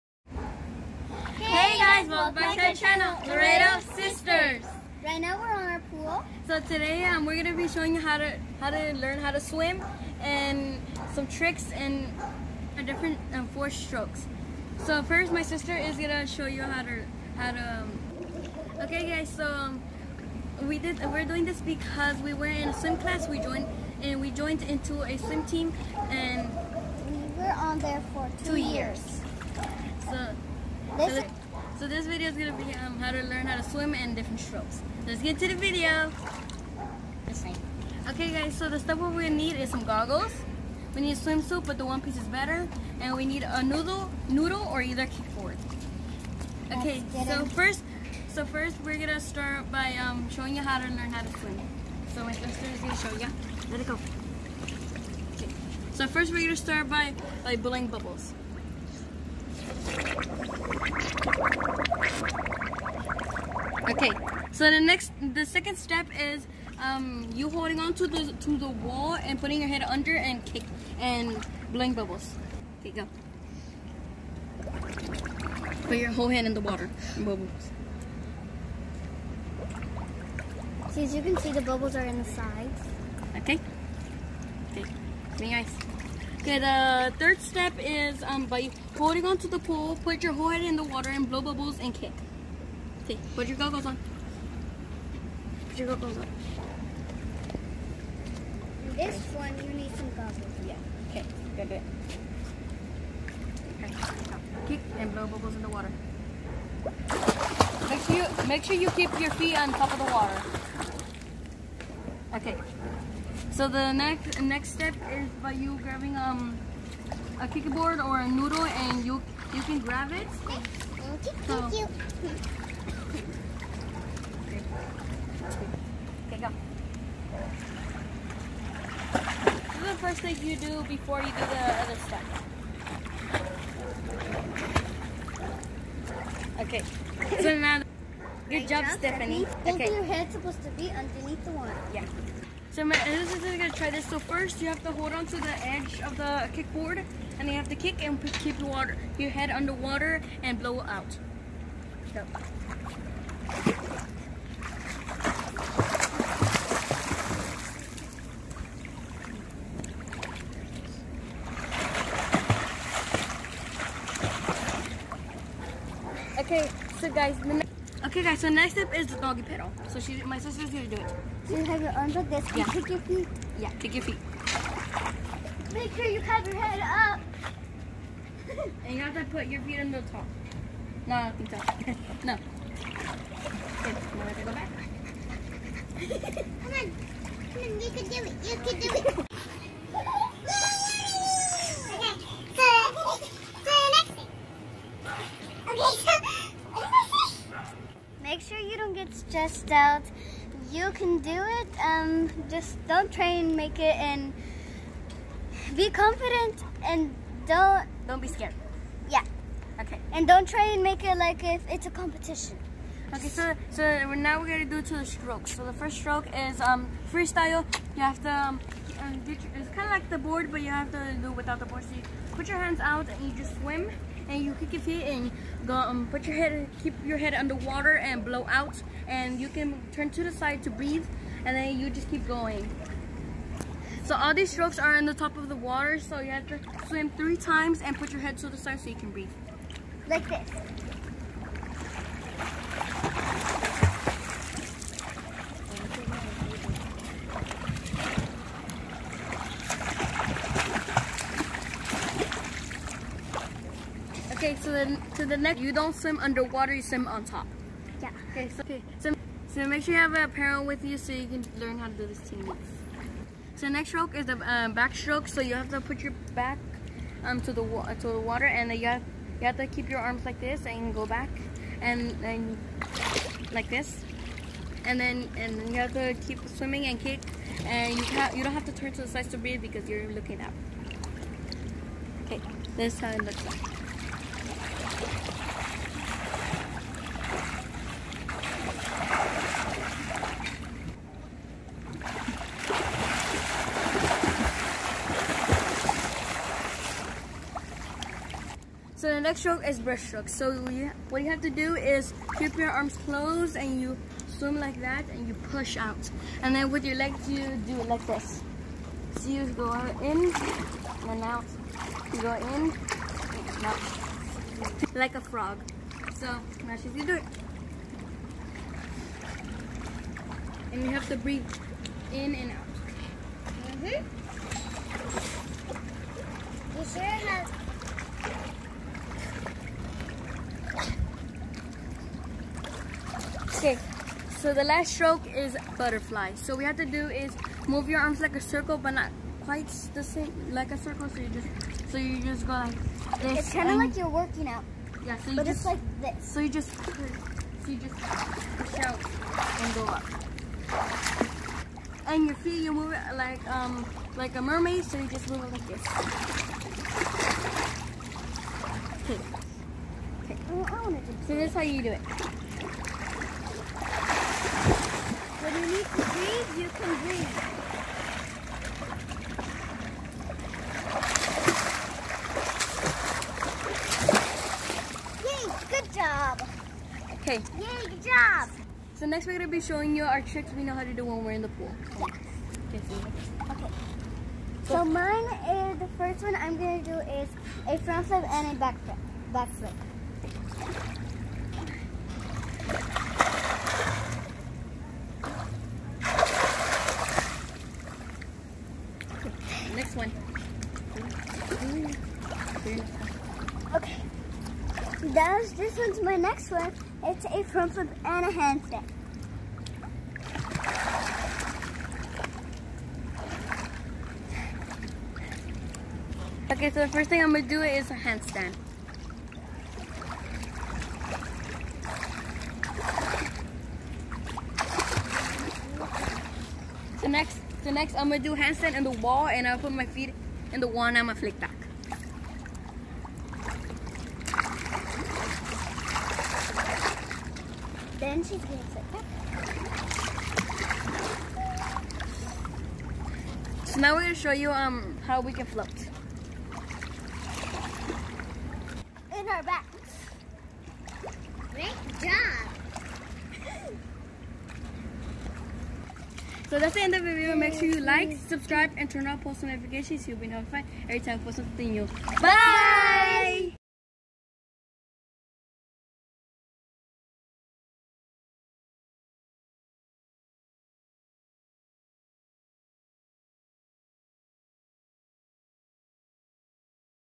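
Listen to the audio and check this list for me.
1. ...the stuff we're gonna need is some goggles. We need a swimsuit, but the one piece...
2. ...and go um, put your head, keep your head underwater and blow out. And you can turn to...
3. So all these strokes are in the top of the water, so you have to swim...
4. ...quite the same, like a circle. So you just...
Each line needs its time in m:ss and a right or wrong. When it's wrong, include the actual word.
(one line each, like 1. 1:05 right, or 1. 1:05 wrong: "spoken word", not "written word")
1. 0:38 right
2. 3:45 right
3. 3:54 right
4. 5:39 right.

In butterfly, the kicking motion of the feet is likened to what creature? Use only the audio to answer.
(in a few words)
mermaid.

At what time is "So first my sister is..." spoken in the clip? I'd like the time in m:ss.
0:14.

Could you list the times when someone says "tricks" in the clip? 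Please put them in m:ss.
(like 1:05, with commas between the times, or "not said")
0:11, 6:20.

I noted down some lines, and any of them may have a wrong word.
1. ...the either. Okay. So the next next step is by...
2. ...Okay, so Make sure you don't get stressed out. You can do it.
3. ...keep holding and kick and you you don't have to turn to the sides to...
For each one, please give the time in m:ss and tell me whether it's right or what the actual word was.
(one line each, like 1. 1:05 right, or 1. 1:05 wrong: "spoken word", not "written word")
1. 1:49 wrong: "water", not "either"
2. 3:16 right
3. 4:36 wrong: "swimming", not "holding".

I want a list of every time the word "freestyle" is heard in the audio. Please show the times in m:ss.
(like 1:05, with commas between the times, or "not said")
3:37.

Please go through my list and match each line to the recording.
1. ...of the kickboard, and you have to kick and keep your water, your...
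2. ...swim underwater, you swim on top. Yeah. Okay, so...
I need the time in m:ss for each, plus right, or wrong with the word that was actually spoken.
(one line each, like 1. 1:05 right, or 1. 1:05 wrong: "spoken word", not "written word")
1. 2:26 right
2. 4:15 right.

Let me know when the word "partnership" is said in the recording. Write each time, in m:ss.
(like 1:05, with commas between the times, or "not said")
not said.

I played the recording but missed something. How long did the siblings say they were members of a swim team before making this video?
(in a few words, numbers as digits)
2 years.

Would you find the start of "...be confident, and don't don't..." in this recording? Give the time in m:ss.
3:25.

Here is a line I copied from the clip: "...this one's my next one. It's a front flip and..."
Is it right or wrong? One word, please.
right.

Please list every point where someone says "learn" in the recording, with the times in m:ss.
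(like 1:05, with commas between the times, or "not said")
0:08, 0:33, 0:50, 4:21.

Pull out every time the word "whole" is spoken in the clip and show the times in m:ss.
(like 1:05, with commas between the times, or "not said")
1:16, 1:30.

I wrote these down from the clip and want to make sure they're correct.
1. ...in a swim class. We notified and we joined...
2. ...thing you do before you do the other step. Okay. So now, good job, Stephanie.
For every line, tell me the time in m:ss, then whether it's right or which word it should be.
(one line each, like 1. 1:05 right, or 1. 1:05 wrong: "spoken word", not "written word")
1. 0:22 wrong: "joined", not "notified"
2. 2:10 right.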